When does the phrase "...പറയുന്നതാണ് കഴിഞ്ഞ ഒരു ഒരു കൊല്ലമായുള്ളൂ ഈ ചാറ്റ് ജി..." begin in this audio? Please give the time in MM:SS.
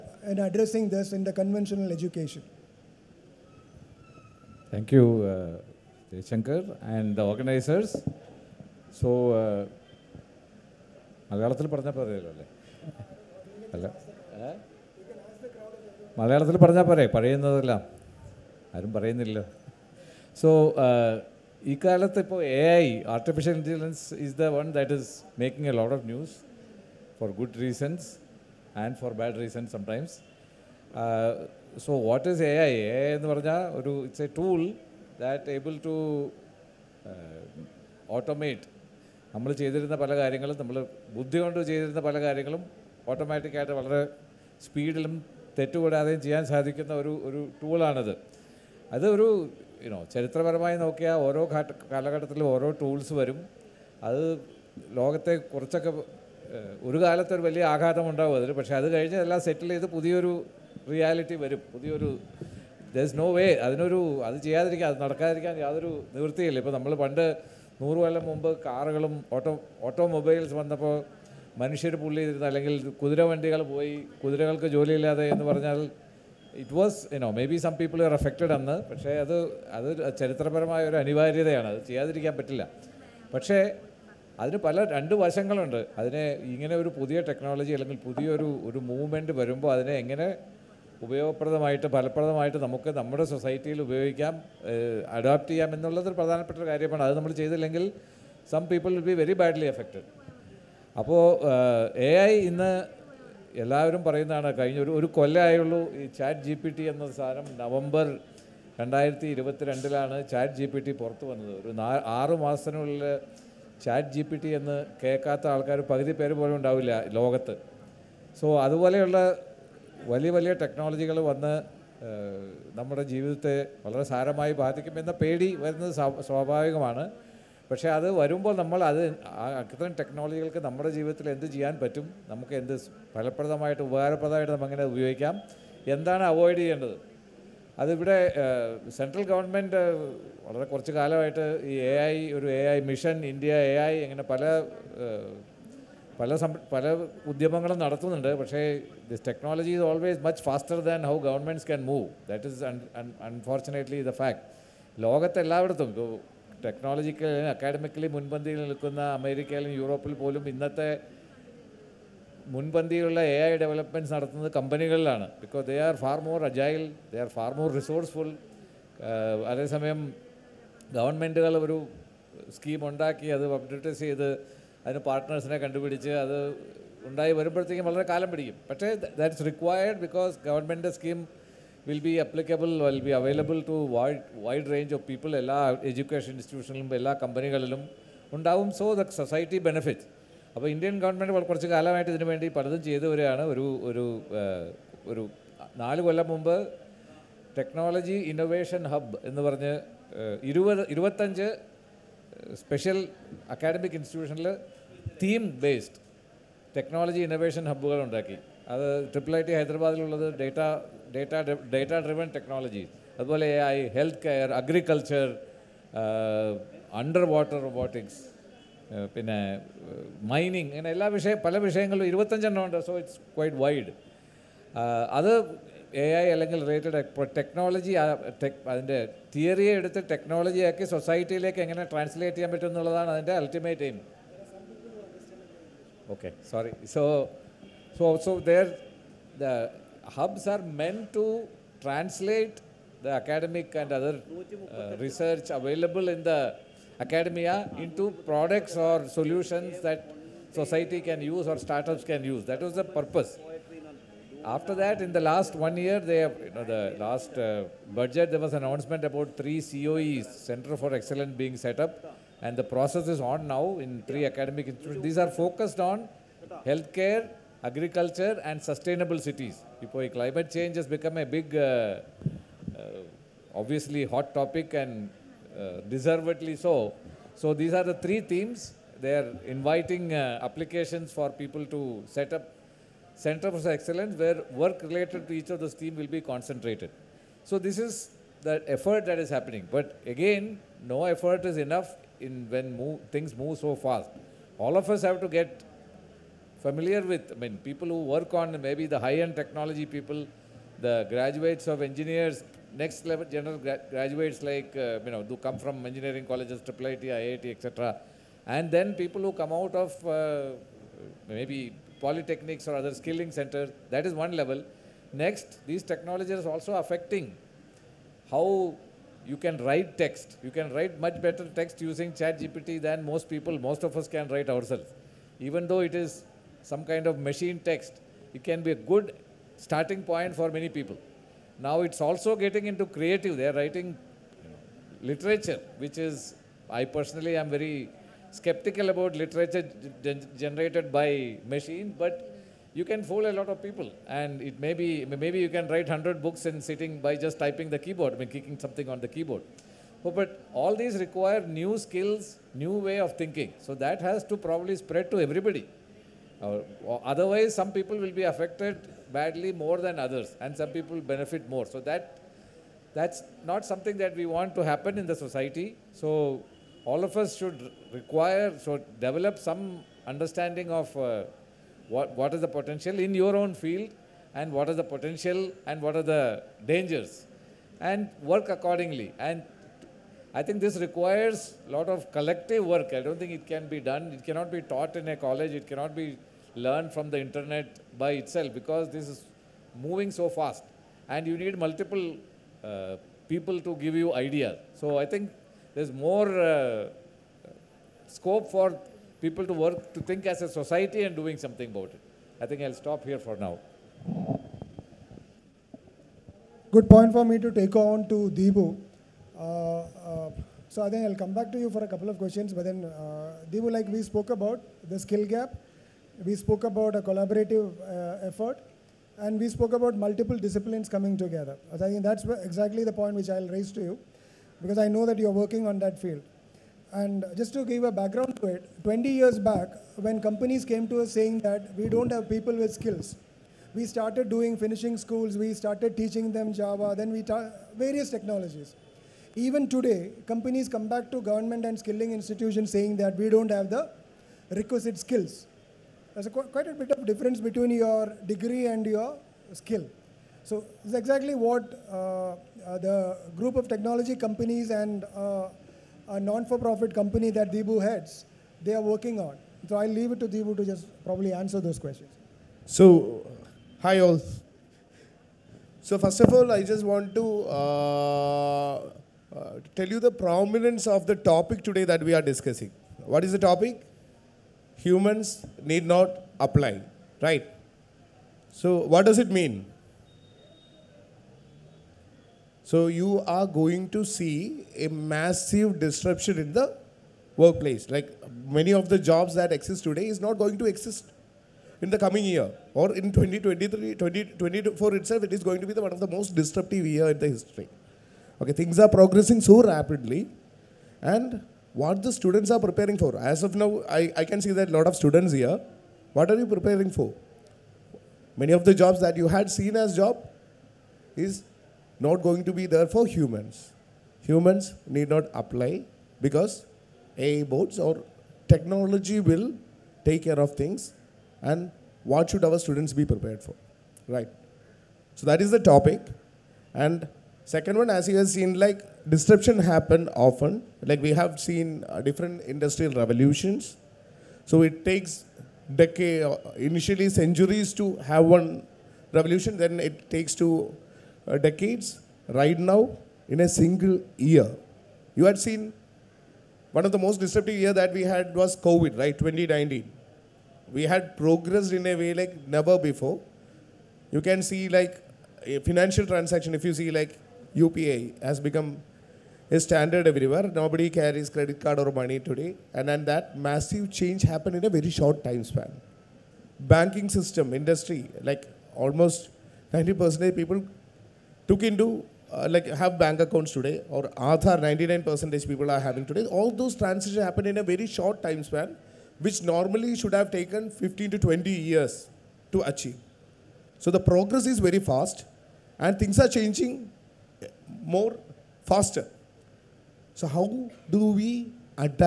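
01:44.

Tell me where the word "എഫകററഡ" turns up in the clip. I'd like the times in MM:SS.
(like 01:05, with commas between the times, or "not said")
01:18, 01:39.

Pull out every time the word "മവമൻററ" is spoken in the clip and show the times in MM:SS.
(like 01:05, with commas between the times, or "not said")
01:28.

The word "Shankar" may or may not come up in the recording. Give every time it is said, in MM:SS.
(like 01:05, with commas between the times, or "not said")
00:06.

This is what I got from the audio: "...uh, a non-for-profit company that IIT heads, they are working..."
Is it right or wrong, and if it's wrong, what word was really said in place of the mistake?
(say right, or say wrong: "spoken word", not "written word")
wrong: "Deepu", not "IIT".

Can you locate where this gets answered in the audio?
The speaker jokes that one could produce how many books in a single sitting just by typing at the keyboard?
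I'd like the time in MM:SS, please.
05:45.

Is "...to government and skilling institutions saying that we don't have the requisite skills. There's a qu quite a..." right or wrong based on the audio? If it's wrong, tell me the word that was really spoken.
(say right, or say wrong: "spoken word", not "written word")
right.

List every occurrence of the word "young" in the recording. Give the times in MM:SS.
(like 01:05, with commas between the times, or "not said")
not said.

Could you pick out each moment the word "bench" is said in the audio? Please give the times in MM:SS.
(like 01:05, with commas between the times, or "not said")
not said.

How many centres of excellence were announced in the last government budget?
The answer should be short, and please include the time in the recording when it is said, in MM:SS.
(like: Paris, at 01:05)
3, at 04:19.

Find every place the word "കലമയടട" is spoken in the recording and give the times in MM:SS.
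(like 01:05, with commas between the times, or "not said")
02:20, 03:11.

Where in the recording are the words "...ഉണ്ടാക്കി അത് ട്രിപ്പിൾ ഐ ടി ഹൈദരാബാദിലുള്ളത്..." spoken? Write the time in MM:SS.
03:28.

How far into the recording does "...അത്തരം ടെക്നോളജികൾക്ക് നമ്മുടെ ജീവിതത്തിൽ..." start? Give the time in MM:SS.
02:09.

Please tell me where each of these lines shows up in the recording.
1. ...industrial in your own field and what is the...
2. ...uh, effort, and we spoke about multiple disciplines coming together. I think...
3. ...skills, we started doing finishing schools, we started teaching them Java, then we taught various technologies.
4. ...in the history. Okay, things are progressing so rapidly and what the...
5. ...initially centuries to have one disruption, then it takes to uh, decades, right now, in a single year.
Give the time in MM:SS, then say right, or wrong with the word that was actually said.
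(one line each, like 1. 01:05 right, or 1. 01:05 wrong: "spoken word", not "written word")
1. 06:12 wrong: "potential", not "industrial"
2. 06:57 right
3. 07:12 right
4. 08:17 right
5. 08:56 wrong: "revolution", not "disruption".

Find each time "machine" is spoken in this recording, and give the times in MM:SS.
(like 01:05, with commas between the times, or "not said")
05:27, 05:41.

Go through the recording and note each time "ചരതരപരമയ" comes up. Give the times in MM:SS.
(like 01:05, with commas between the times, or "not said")
00:50, 01:20.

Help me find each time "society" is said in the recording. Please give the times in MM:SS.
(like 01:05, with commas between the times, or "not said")
04:10, 06:05, 06:40.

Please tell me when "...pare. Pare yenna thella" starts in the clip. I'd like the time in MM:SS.
00:16.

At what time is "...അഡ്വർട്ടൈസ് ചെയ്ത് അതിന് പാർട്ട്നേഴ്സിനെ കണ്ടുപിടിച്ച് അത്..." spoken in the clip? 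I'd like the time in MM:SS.
02:53.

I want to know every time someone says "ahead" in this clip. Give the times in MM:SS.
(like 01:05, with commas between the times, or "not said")
not said.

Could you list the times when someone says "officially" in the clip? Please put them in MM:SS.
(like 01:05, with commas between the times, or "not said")
not said.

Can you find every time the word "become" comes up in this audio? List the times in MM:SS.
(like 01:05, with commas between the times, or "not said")
04:30, 09:18.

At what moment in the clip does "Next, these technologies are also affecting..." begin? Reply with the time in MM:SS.
05:15.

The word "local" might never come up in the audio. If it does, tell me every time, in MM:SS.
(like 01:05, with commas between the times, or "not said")
not said.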